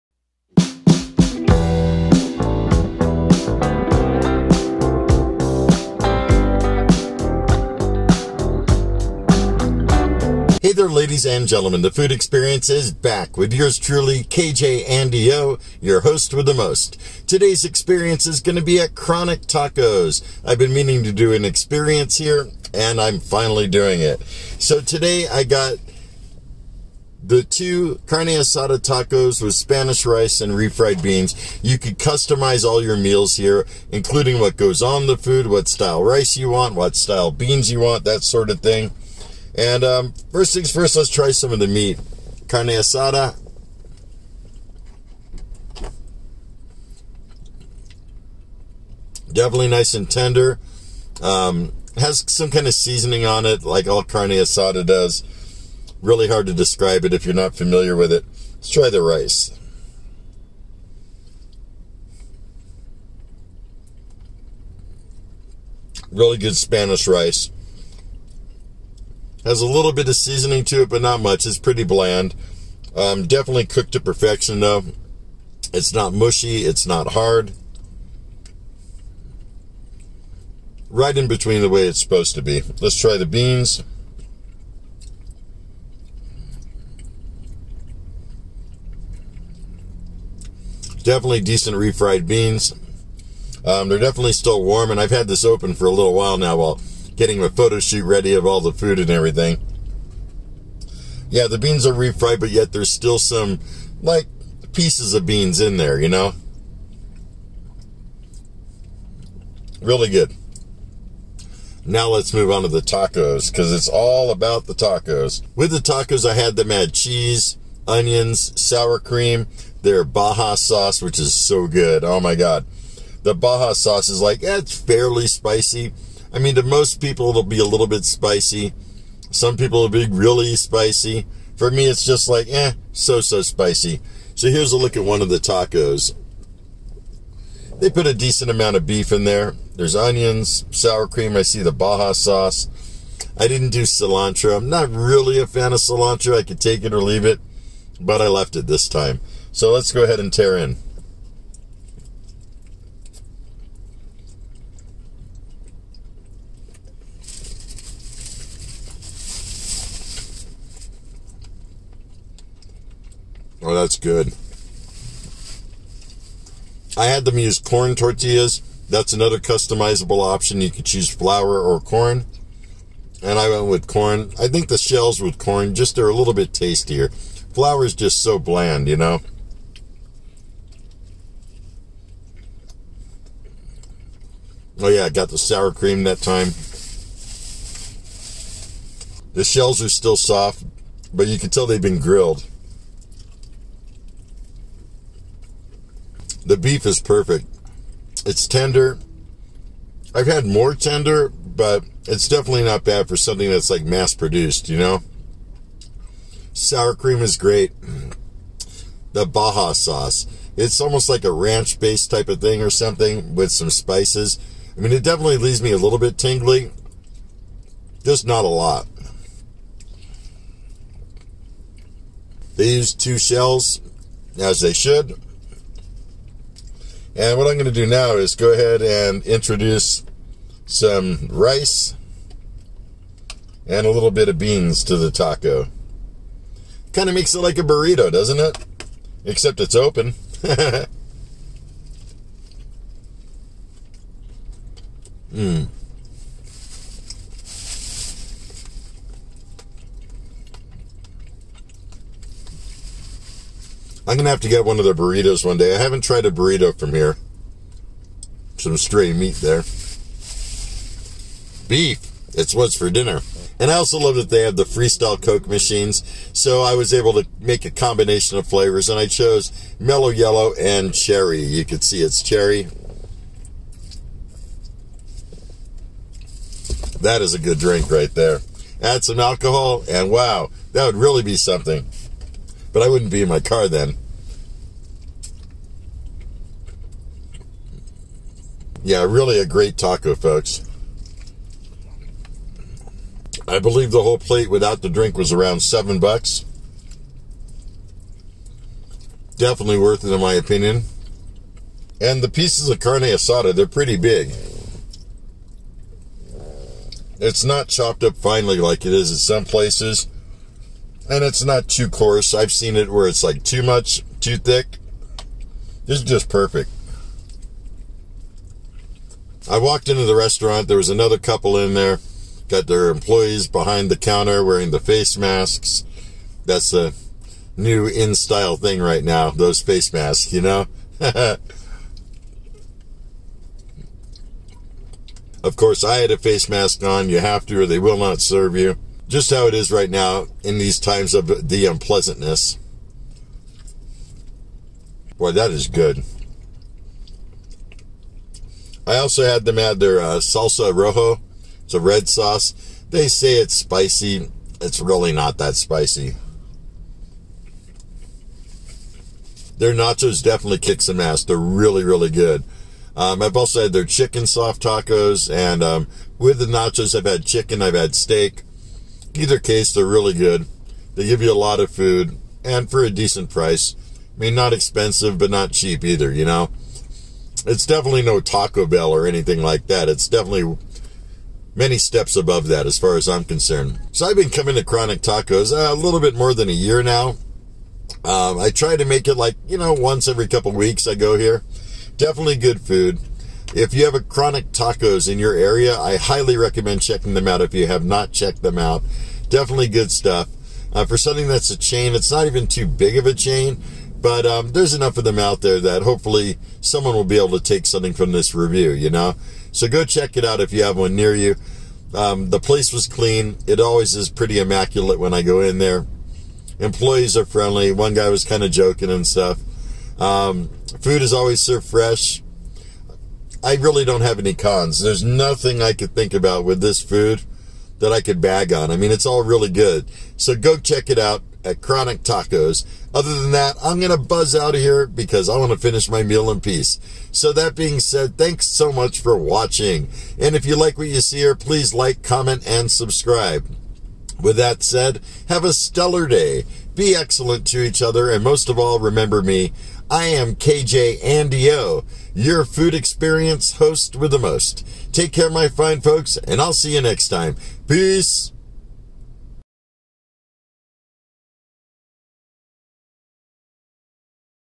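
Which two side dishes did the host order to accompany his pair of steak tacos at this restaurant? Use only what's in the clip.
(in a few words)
Spanish rice and refried beans.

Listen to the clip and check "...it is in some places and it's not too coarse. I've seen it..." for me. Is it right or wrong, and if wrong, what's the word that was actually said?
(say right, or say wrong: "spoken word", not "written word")
right.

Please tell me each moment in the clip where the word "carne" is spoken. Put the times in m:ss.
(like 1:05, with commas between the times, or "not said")
0:28, 0:42, 0:54, 5:02.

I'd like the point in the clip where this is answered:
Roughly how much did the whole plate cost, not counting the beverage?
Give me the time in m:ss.
4:55.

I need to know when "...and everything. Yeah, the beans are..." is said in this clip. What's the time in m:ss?
1:38.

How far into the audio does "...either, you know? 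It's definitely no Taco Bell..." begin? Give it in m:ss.
6:15.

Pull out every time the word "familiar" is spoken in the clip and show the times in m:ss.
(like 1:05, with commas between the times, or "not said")
0:57.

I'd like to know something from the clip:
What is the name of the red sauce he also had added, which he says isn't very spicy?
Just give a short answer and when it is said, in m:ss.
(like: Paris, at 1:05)
Salsa rojo, at 5:50.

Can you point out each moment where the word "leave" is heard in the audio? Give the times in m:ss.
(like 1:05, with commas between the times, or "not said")
2:27, 3:35.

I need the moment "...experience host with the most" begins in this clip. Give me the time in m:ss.
7:32.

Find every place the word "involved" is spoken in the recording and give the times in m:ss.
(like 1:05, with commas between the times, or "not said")
not said.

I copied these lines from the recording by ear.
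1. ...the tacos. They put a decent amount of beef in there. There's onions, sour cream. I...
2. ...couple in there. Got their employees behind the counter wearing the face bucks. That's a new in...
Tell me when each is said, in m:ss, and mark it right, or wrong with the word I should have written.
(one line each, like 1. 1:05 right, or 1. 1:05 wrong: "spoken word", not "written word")
1. 2:15 right
2. 5:21 wrong: "masks", not "bucks".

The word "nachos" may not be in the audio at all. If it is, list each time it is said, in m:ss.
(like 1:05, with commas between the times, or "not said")
5:59, 6:06.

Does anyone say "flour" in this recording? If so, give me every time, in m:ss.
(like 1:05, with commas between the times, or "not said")
2:51, 2:57.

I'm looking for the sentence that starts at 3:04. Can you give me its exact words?
Oh yeah, I got the sour cream that time.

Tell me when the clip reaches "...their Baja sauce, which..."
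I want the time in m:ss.
1:59.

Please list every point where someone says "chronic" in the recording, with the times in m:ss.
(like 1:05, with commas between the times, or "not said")
0:18, 6:24, 6:33, 7:11.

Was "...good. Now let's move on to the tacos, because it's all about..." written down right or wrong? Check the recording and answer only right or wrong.
right.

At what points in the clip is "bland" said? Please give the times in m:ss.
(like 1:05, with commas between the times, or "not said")
1:11, 2:58.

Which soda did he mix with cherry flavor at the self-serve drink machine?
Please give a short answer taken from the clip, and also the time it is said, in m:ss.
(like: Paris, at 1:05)
Mello Yello, at 4:29.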